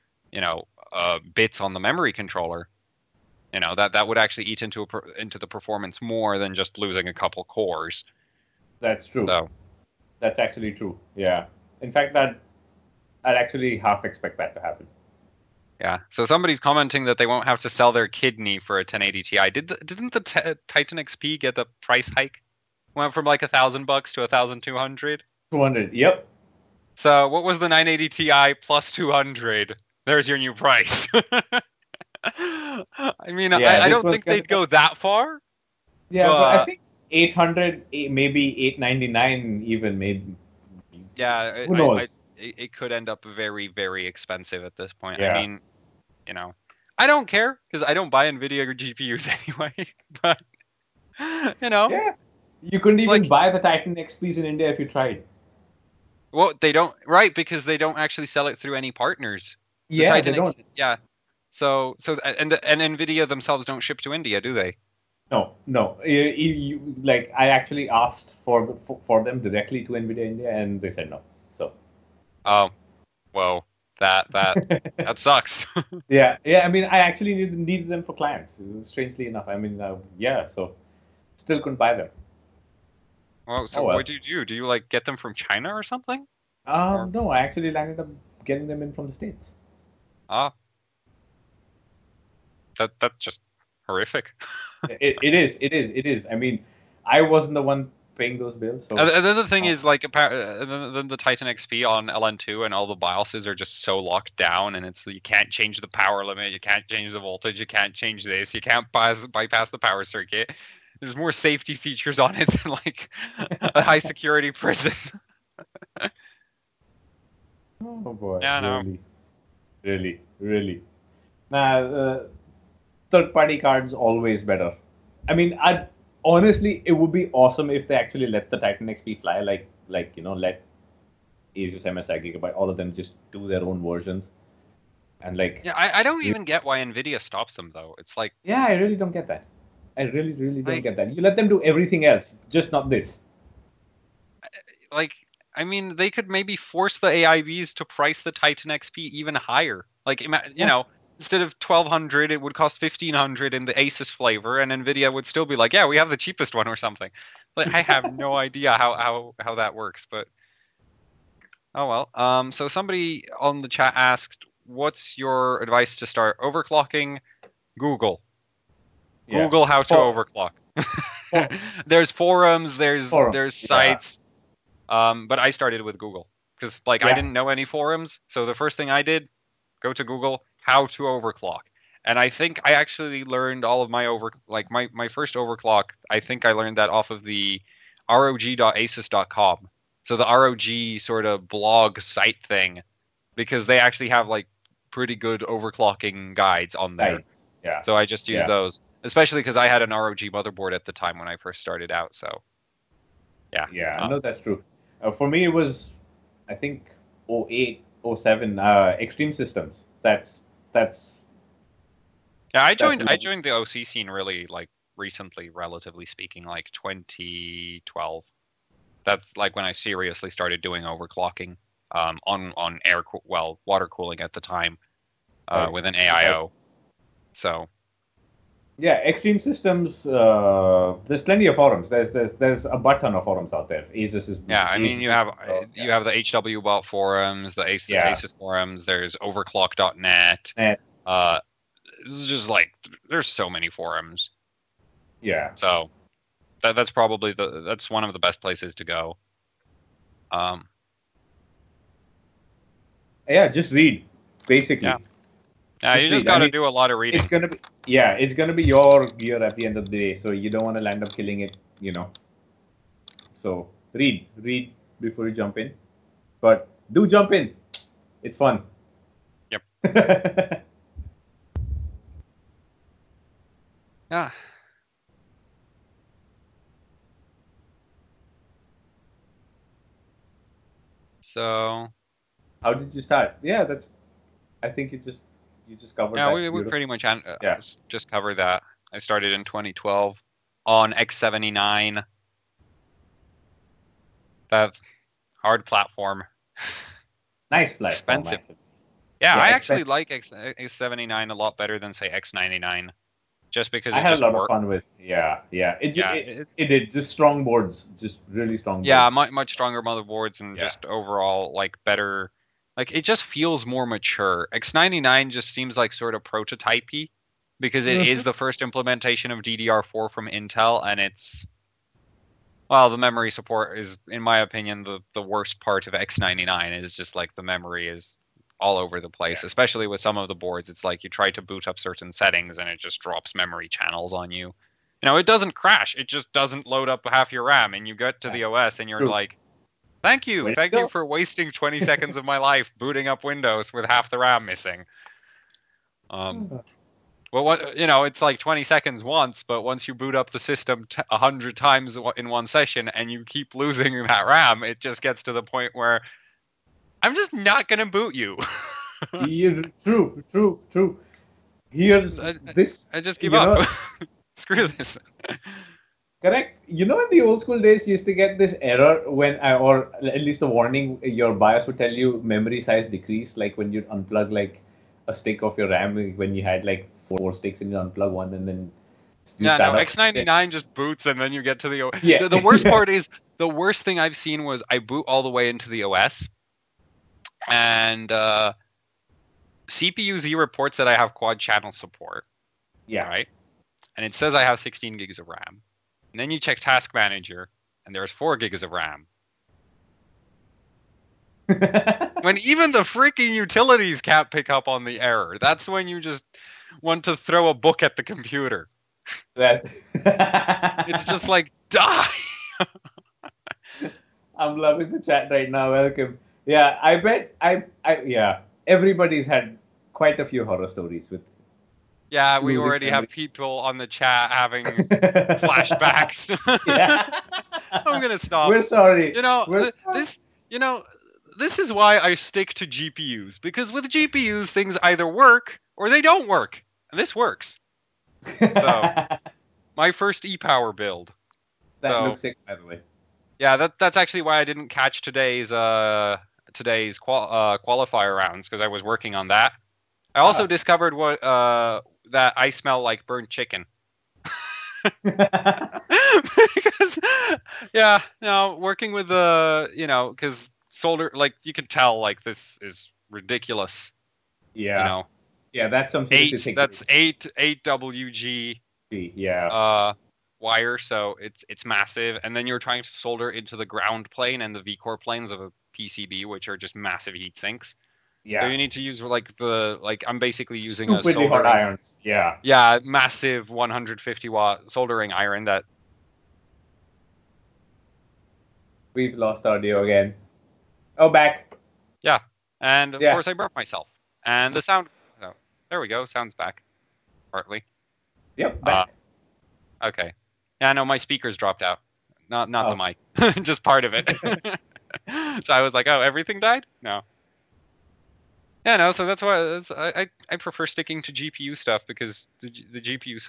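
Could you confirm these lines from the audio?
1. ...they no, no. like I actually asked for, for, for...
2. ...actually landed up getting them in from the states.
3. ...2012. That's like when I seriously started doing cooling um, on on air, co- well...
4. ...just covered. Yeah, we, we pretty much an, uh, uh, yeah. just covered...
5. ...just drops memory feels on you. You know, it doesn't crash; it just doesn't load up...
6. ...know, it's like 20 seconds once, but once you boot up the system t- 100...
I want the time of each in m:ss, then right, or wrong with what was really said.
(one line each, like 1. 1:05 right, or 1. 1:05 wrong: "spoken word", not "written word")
1. 1:04 right
2. 1:27 right
3. 3:36 wrong: "overclocking", not "cooling"
4. 4:45 right
5. 5:32 wrong: "channels", not "feels"
6. 5:47 right.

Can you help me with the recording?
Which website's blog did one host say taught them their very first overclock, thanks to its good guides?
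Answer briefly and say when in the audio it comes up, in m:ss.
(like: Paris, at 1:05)
rog.asus.com, at 3:08.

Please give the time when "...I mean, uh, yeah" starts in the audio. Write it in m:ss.
1:19.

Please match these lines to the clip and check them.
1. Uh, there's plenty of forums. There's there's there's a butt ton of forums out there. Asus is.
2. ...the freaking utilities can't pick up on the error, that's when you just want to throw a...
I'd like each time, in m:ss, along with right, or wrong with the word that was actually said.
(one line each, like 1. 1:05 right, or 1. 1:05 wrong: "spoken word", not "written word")
1. 3:50 right
2. 6:42 right.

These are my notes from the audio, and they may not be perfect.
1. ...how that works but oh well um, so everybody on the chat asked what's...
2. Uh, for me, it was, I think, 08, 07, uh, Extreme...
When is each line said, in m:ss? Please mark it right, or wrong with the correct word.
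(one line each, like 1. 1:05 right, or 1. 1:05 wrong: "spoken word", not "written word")
1. 2:39 wrong: "somebody", not "everybody"
2. 3:25 right.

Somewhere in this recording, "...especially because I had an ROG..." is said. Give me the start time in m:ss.
3:19.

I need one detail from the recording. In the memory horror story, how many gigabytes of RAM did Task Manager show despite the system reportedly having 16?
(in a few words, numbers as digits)
4.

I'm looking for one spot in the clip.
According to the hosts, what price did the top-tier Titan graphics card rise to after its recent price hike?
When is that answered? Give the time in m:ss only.
0:24.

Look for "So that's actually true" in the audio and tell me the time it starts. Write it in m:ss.
0:09.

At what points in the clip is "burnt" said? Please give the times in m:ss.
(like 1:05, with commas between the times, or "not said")
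7:33, 8:13.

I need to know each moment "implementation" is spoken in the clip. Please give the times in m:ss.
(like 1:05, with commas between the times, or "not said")
5:18.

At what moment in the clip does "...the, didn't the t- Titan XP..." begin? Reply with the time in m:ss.
0:19.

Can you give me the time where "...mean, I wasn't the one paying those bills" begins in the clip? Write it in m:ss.
1:36.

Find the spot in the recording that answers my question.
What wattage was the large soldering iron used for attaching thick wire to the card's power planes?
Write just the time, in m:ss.
8:03.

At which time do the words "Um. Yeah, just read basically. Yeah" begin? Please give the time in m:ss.
4:10.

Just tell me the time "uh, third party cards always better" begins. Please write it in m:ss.
2:01.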